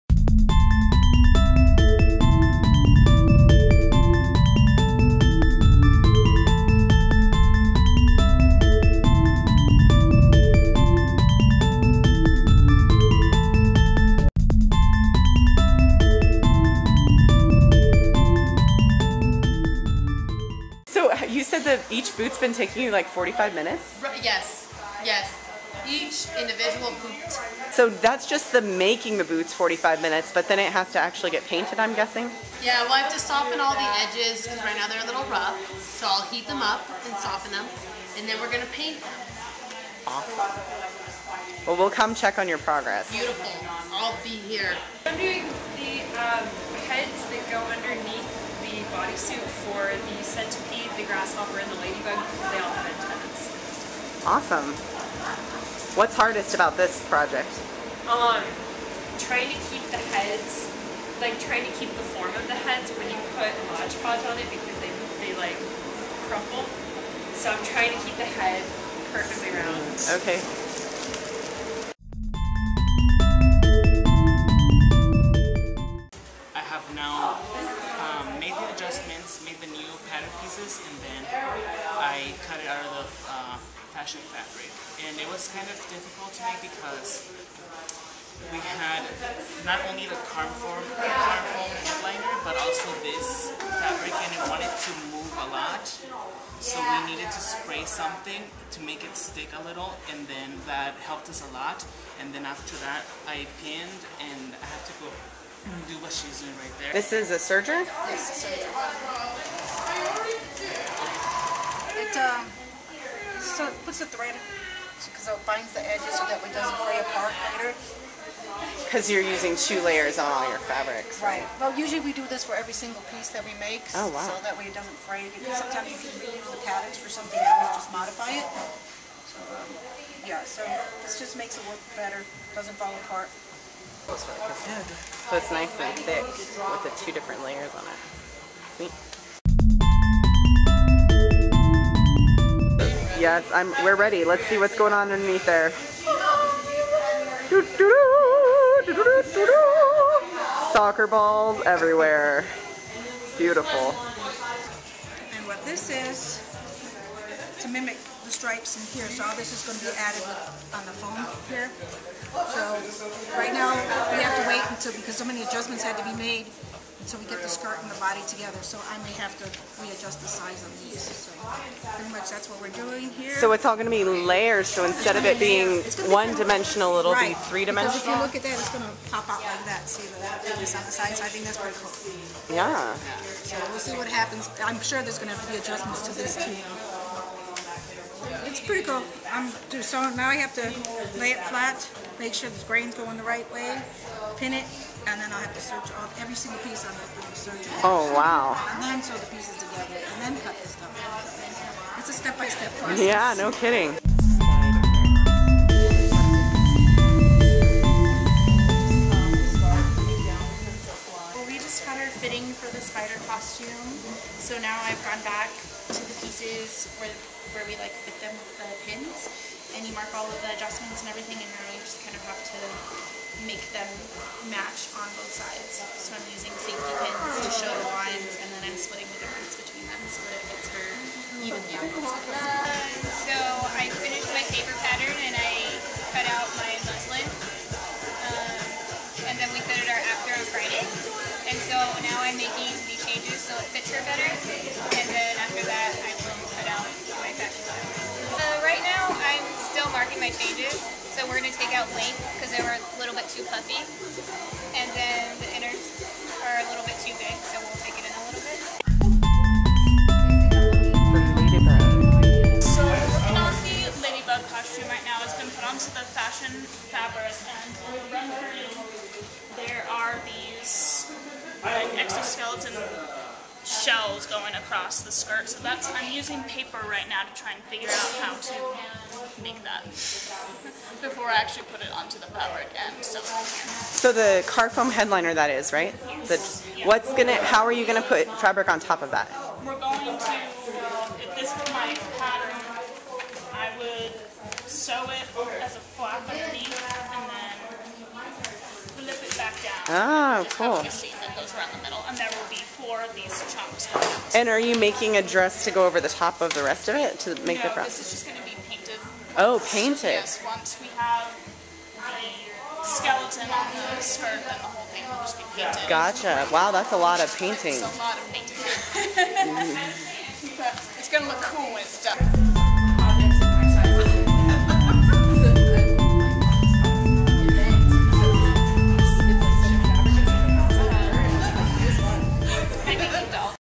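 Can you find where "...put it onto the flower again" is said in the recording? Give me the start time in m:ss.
4:41.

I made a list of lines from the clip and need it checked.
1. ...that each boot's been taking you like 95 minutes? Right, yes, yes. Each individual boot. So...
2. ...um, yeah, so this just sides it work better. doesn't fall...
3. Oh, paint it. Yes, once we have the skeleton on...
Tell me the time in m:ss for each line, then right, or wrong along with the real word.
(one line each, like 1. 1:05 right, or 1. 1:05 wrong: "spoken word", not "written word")
1. 0:21 wrong: "45", not "95"
2. 2:09 wrong: "makes", not "sides"
3. 5:09 right.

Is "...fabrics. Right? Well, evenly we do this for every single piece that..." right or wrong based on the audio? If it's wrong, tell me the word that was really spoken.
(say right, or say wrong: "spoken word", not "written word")
wrong: "usually", not "evenly".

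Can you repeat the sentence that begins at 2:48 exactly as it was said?
So I may have to readjust the size on these.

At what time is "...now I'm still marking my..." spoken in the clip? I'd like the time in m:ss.
4:08.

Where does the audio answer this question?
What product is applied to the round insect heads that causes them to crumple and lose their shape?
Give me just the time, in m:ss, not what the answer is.
1:03.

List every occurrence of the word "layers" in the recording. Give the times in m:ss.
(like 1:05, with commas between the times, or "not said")
1:59, 2:17, 2:54.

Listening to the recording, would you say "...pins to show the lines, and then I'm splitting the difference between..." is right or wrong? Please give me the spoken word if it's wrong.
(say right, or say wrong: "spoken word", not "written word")
right.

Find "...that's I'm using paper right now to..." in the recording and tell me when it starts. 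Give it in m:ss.
4:35.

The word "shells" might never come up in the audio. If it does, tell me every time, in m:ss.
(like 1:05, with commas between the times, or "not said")
4:33.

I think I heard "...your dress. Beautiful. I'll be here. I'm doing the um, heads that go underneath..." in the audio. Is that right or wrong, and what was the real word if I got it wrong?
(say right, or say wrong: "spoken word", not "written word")
wrong: "progress", not "dress".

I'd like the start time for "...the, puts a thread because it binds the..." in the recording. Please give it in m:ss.
1:53.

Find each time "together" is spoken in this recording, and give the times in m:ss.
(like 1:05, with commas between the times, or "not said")
2:48, 3:19.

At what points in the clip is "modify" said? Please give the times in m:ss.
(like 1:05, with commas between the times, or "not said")
2:07.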